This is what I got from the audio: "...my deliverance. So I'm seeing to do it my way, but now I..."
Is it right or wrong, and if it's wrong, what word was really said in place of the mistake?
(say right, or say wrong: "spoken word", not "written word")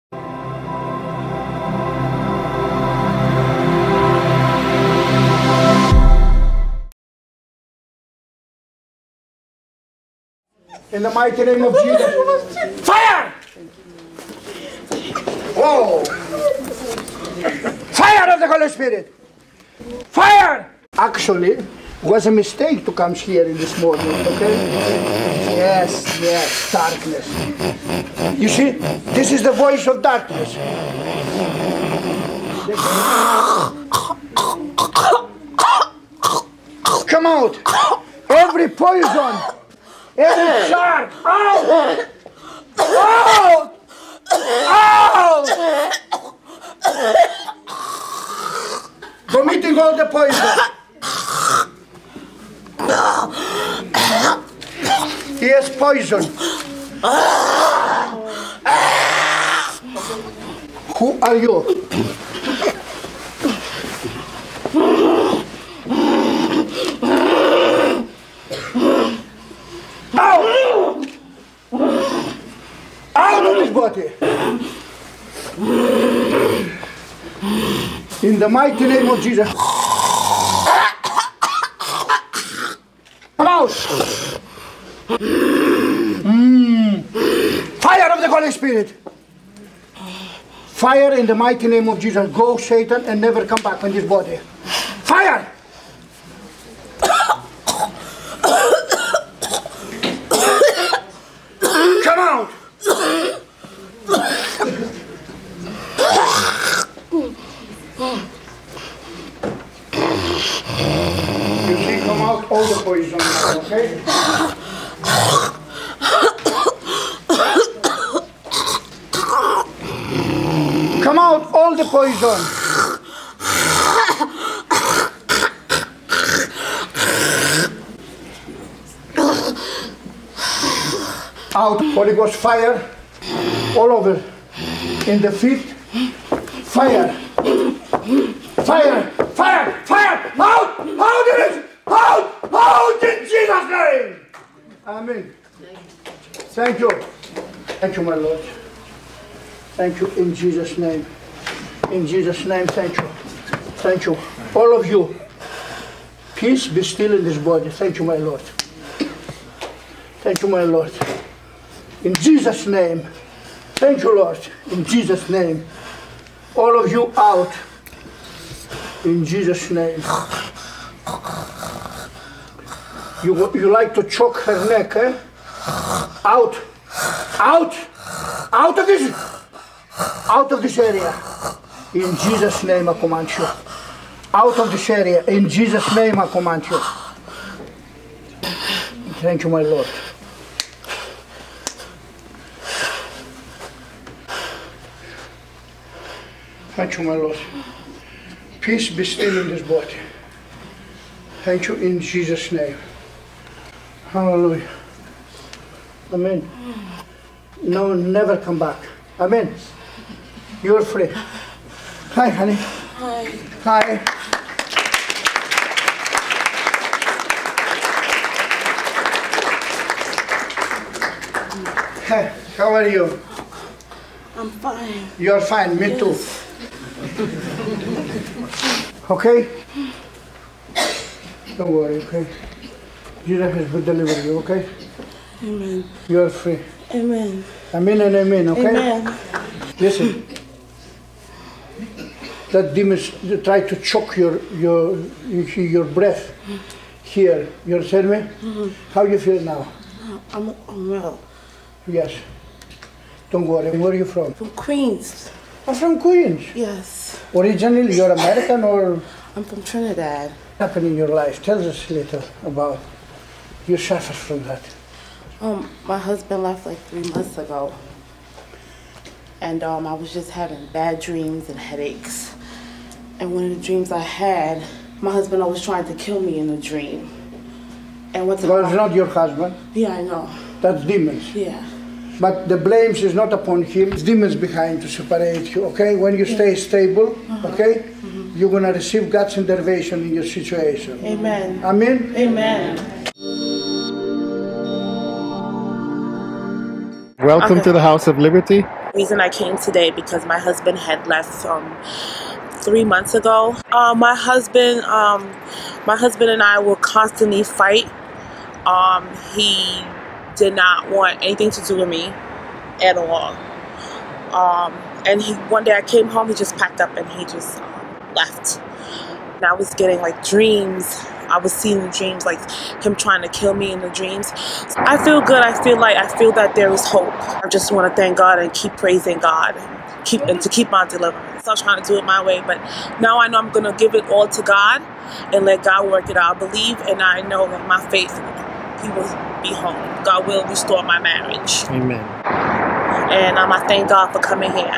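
wrong: "trying", not "seeing".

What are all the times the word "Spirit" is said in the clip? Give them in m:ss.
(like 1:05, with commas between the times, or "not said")
0:18, 1:28.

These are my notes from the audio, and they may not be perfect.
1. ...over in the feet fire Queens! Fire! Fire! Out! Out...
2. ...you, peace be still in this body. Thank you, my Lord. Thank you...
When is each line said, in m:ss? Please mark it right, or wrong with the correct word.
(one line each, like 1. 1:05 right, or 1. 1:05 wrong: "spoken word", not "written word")
1. 2:13 wrong: "Fire", not "Queens"
2. 2:34 right.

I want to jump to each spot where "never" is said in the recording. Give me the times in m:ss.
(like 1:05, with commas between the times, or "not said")
1:33, 3:27.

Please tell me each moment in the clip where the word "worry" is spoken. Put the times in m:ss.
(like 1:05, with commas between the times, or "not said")
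3:51, 4:13.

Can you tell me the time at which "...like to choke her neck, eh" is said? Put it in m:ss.
2:53.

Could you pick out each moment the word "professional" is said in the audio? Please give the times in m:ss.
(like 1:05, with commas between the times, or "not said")
not said.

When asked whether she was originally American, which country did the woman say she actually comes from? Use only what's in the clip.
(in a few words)
Trinidad.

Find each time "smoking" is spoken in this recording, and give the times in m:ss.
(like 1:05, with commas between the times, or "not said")
not said.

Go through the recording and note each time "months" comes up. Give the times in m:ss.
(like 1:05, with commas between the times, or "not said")
4:27, 5:02.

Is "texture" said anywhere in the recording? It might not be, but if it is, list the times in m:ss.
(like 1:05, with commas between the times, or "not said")
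not said.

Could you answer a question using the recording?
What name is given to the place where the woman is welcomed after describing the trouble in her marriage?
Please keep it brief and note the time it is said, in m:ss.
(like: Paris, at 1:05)
House of Liberty, at 4:57.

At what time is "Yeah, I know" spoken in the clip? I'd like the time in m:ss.
4:39.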